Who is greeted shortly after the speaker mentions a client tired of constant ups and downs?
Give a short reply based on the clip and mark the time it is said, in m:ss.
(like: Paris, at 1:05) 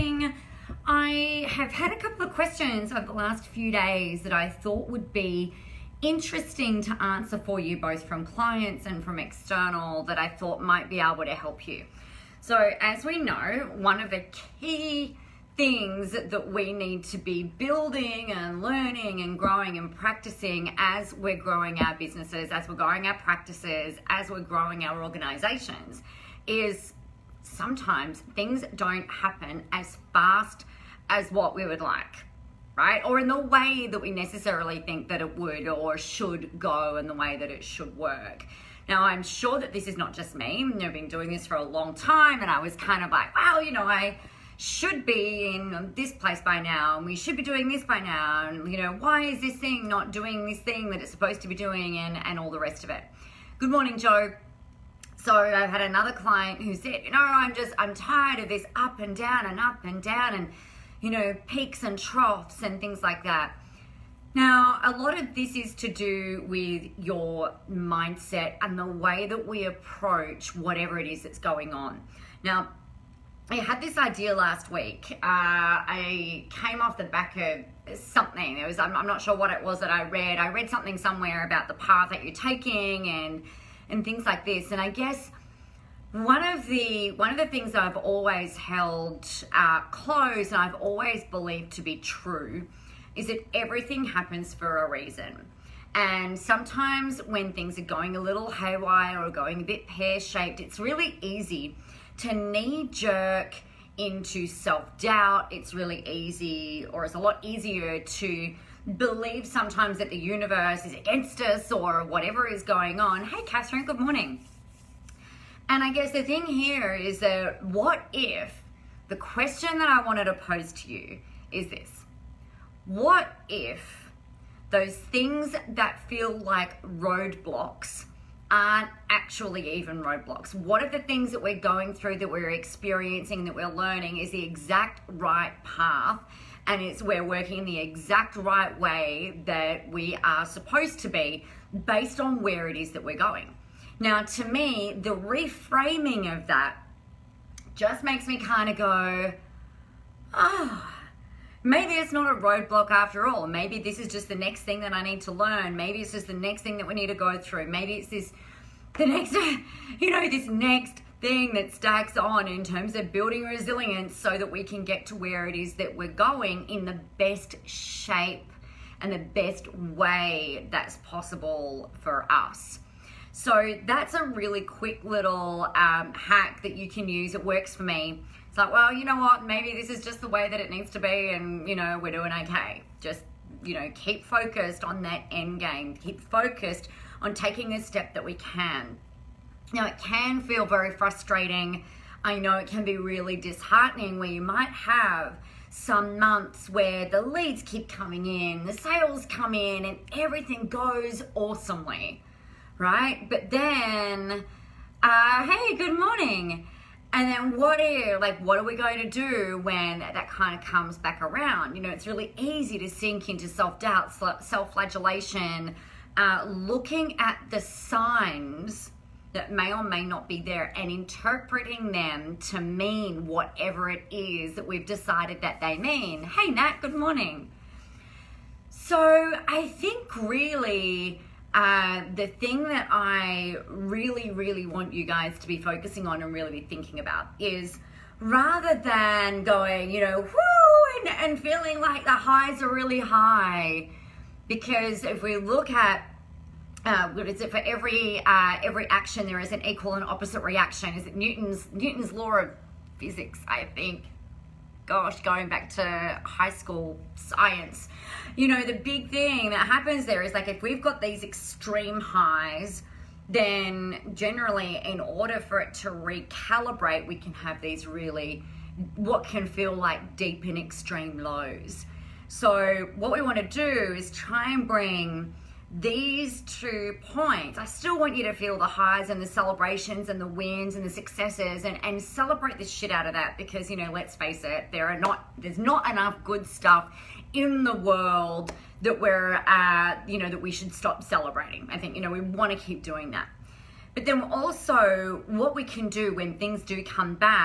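Joe, at 0:53.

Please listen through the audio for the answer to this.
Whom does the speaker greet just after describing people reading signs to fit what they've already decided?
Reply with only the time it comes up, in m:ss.
3:46.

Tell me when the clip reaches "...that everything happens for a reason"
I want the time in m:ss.
1:33.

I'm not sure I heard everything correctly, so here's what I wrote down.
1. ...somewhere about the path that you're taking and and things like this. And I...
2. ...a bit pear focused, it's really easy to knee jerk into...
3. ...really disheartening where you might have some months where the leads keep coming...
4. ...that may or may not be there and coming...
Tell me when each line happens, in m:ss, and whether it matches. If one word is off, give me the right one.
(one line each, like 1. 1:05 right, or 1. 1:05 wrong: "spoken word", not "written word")
1. 1:20 right
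2. 1:39 wrong: "shaped", not "focused"
3. 3:12 right
4. 3:39 wrong: "interpreting", not "coming".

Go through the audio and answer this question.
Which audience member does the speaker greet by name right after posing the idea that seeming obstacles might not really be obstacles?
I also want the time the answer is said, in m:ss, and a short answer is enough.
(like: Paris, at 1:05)
Catherine, at 1:53.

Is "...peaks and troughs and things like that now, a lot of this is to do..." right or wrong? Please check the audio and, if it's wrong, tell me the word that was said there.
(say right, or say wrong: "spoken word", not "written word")
right.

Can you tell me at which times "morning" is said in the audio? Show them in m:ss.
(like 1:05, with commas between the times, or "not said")
0:53, 1:53, 3:25, 3:46.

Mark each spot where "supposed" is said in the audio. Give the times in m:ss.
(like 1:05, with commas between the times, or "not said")
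0:51, 2:20.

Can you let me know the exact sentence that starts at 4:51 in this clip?
I think, you know, we want to keep doing that.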